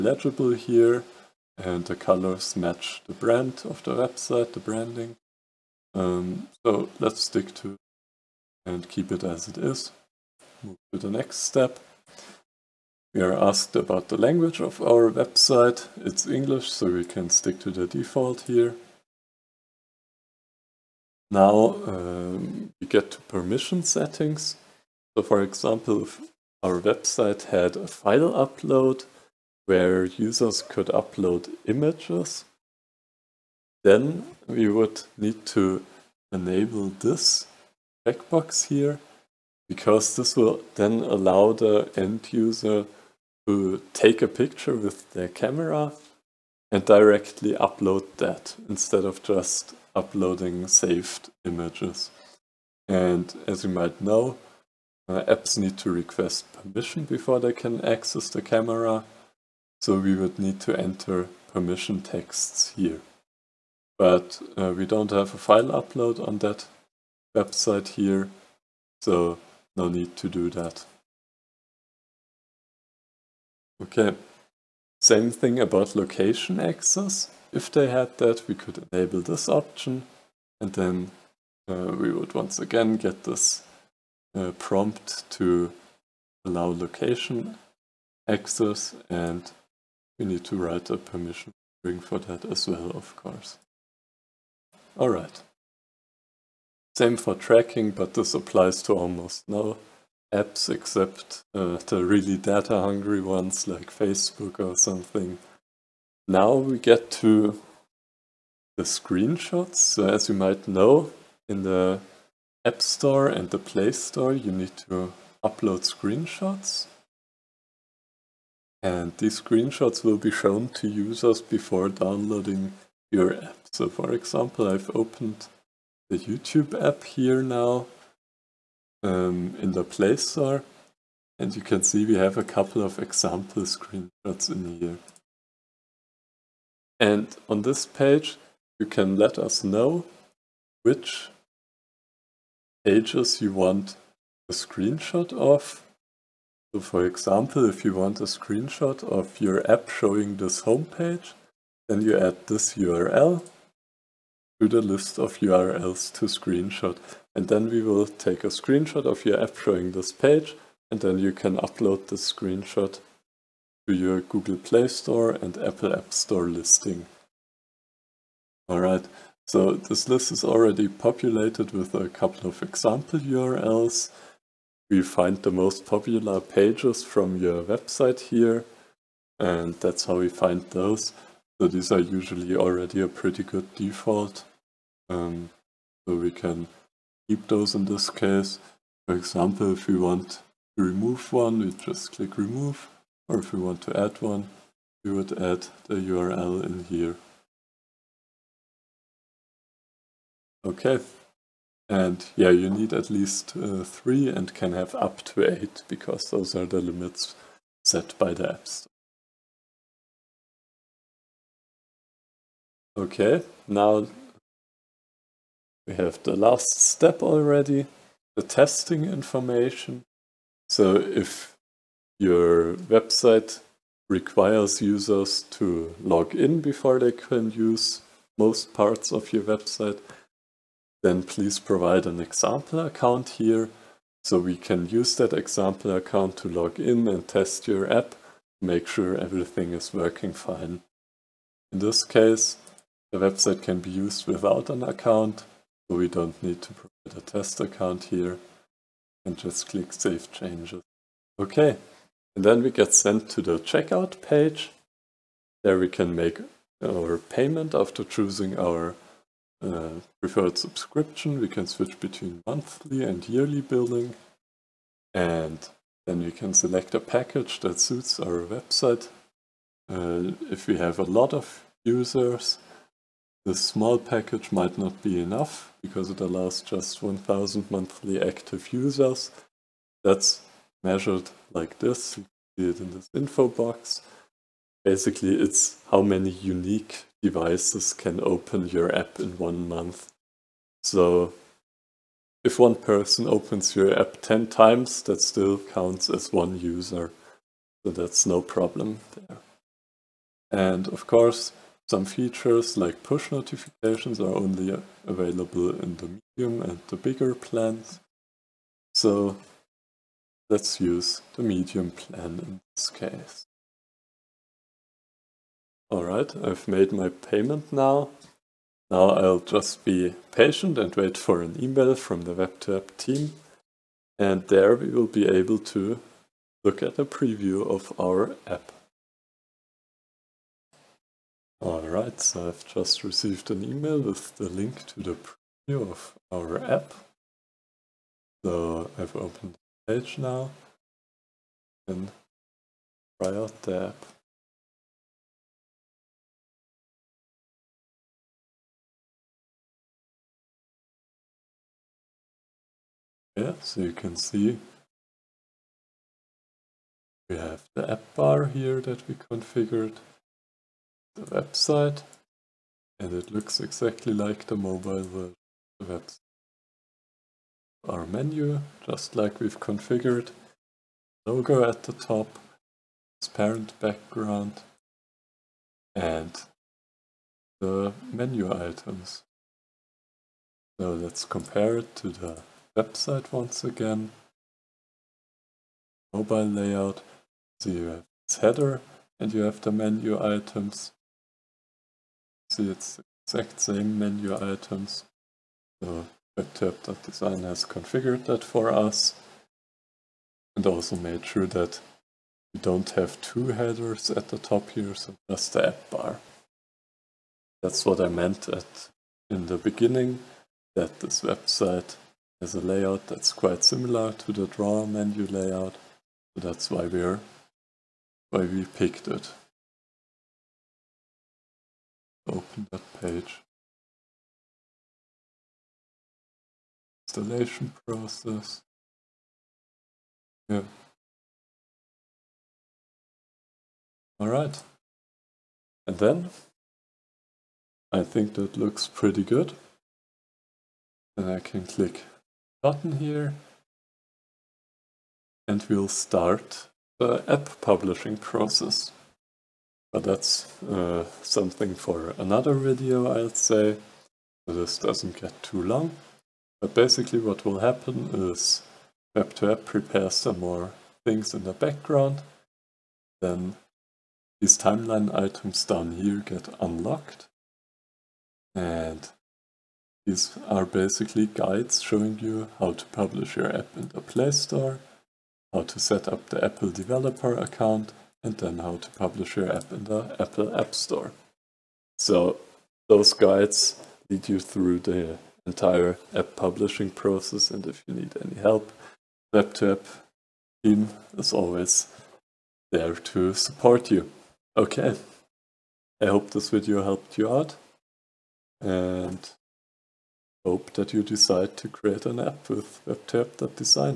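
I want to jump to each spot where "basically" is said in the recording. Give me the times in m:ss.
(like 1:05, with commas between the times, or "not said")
4:44, 7:36, 7:50.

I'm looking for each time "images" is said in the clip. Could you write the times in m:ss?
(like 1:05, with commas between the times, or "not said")
0:31, 0:51.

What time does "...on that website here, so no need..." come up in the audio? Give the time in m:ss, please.
1:06.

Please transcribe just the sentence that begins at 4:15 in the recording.
There we can make our payment after choosing our uh, preferred subscription.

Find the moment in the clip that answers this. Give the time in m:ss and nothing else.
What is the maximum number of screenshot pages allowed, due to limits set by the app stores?
3:25.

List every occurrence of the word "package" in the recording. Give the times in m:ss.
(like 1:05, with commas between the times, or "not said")
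4:26, 4:33.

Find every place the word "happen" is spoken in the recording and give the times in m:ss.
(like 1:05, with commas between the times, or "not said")
7:37.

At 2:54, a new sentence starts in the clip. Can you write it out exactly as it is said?
We find the most popular pages from your website here, and that's how we find those.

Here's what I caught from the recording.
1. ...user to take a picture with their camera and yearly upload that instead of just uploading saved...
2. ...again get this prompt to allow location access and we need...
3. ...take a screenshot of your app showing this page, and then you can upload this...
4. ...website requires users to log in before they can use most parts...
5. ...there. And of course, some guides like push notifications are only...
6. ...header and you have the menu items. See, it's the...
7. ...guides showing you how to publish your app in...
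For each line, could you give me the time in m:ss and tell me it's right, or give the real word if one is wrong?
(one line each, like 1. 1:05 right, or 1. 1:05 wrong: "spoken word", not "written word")
1. 0:42 wrong: "directly", not "yearly"
2. 1:22 right
3. 2:38 right
4. 3:42 right
5. 4:59 wrong: "features", not "guides"
6. 6:28 right
7. 7:51 right.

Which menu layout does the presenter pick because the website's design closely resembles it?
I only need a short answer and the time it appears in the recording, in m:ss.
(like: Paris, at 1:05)
Draw menu layout, at 6:54.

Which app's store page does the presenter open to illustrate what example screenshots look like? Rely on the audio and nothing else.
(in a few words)
YouTube.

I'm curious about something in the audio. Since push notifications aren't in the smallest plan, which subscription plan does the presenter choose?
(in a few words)
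Medium plan.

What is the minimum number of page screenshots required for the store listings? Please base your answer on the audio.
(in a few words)
3.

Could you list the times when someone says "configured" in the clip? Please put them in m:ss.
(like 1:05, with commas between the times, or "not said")
5:59, 6:09, 6:37.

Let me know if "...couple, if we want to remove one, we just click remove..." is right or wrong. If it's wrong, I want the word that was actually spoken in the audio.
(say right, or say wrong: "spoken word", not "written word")
wrong: "example", not "couple".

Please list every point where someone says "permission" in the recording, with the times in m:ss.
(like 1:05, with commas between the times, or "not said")
0:23, 0:56, 1:01, 1:30.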